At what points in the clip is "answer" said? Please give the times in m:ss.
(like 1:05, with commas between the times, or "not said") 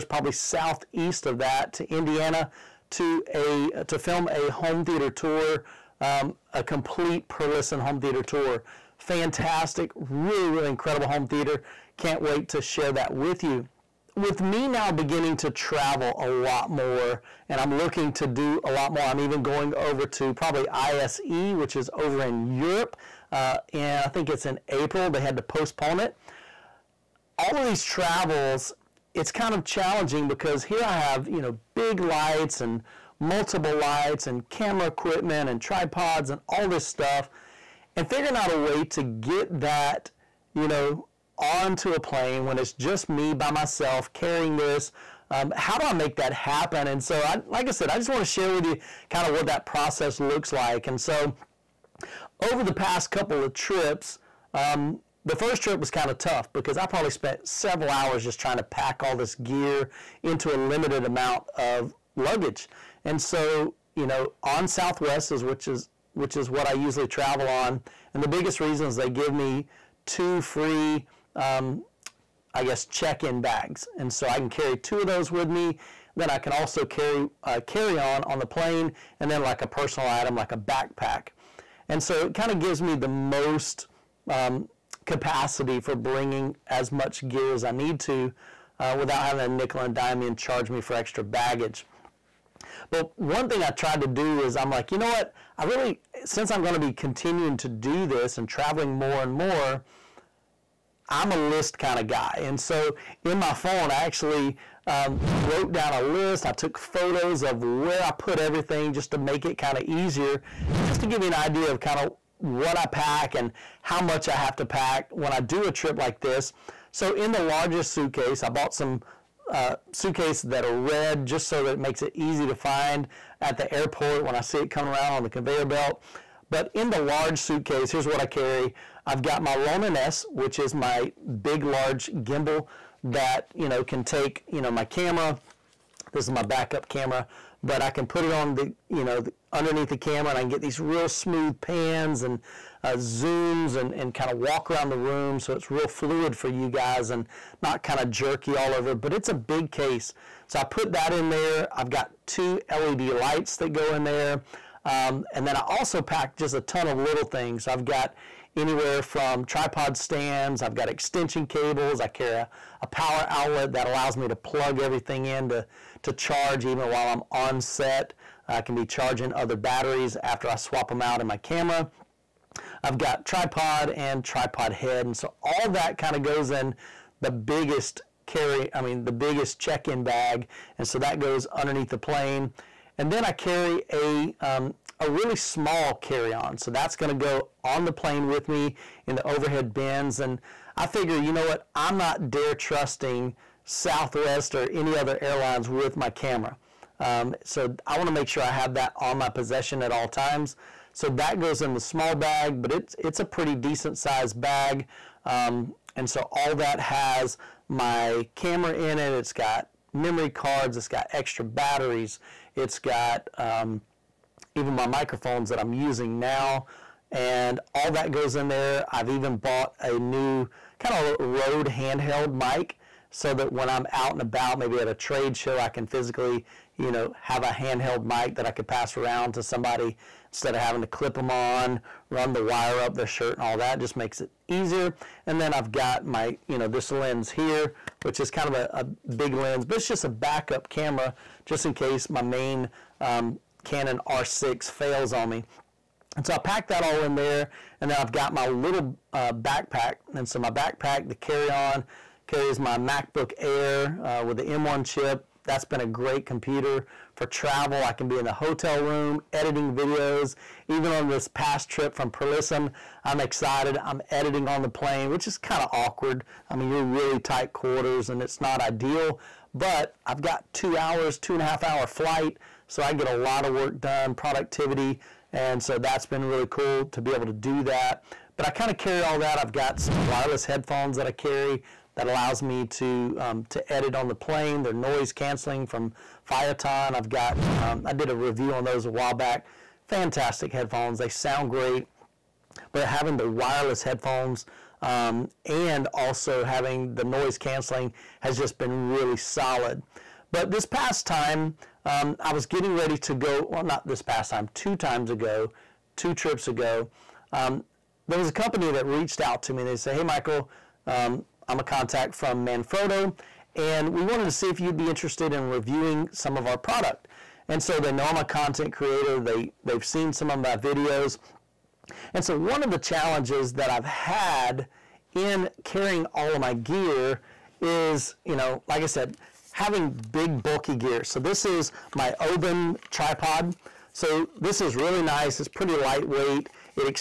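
not said.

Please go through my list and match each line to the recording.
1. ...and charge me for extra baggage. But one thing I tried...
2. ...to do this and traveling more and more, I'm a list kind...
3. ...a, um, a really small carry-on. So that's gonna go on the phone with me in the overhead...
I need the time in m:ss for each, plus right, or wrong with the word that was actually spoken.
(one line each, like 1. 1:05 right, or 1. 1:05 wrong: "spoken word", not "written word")
1. 1:30 right
2. 1:37 right
3. 3:03 wrong: "plane", not "phone".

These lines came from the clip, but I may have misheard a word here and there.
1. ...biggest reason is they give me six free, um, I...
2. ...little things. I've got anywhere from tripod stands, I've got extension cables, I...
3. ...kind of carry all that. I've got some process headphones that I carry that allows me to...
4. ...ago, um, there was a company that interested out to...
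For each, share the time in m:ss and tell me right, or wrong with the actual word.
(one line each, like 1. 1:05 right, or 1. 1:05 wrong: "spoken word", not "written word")
1. 1:08 wrong: "two", not "six"
2. 2:36 right
3. 4:38 wrong: "wireless", not "process"
4. 5:06 wrong: "reached", not "interested".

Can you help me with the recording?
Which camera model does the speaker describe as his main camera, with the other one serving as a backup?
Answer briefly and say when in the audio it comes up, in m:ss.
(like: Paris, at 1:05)
Canon R6, at 4:03.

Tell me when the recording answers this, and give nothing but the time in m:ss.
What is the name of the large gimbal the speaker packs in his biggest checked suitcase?
2:09.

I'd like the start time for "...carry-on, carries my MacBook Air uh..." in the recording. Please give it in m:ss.
4:11.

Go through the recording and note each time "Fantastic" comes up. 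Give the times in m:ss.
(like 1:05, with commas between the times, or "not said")
0:08, 4:49.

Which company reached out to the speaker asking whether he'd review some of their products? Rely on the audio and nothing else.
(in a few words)
Manfrotto.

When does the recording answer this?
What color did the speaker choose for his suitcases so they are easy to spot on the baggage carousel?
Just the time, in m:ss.
2:00.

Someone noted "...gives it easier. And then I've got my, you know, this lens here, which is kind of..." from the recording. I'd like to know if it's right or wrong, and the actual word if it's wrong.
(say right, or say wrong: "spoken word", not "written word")
wrong: "makes", not "gives".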